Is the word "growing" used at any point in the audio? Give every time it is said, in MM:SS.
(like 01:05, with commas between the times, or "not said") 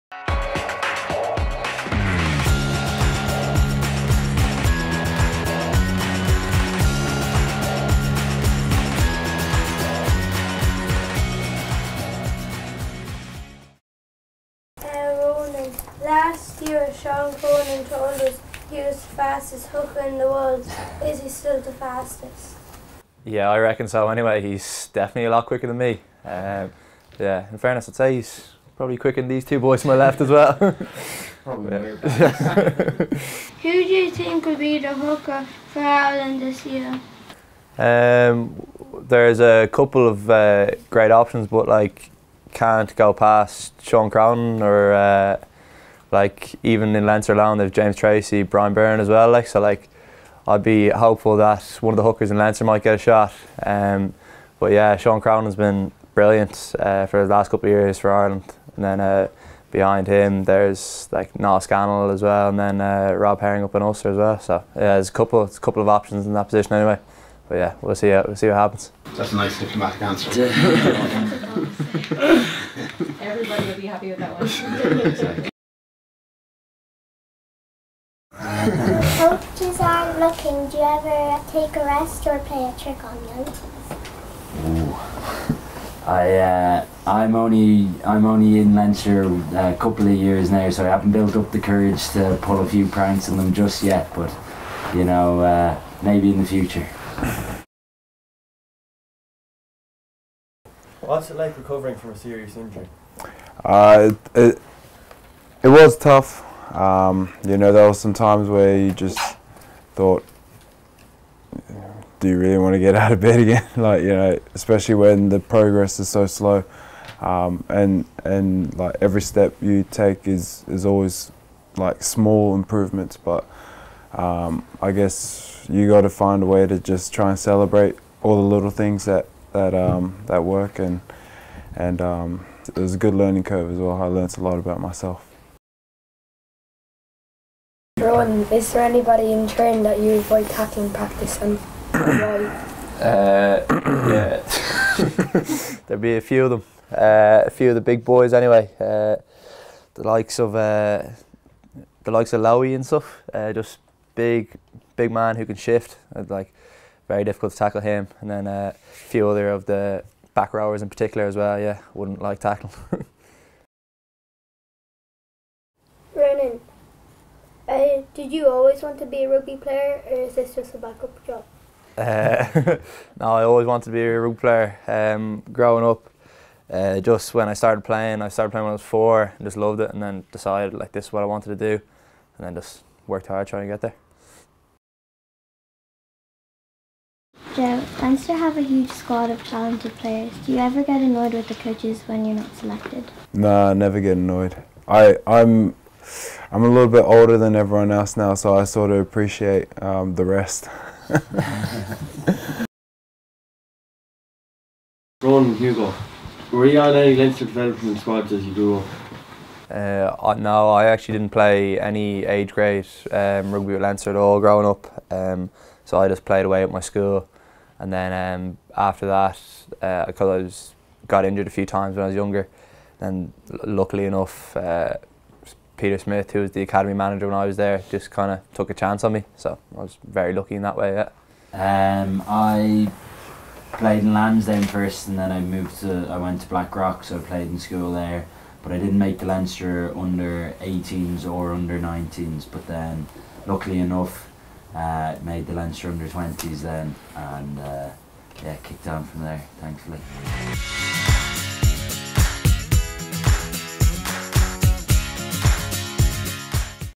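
02:55, 03:34.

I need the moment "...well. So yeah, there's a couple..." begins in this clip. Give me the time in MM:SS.
01:04.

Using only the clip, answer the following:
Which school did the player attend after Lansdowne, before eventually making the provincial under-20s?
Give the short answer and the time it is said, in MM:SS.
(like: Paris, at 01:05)
Blackrock, at 03:56.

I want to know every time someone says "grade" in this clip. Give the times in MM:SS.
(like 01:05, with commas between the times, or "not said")
03:32.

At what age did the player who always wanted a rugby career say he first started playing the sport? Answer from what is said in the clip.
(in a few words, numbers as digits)
4.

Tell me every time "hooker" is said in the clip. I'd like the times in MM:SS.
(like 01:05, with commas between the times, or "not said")
00:19, 00:34, 00:52.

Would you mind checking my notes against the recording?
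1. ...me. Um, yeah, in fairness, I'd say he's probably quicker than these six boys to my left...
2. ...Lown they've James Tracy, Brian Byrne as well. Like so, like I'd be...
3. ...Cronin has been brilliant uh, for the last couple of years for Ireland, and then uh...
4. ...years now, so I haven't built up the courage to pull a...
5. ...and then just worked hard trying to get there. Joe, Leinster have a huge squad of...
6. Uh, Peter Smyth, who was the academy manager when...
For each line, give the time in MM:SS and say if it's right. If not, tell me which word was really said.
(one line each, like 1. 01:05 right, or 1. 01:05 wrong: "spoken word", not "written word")
1. 00:25 wrong: "two", not "six"
2. 00:47 right
3. 00:55 right
4. 01:30 right
5. 03:02 right
6. 03:44 right.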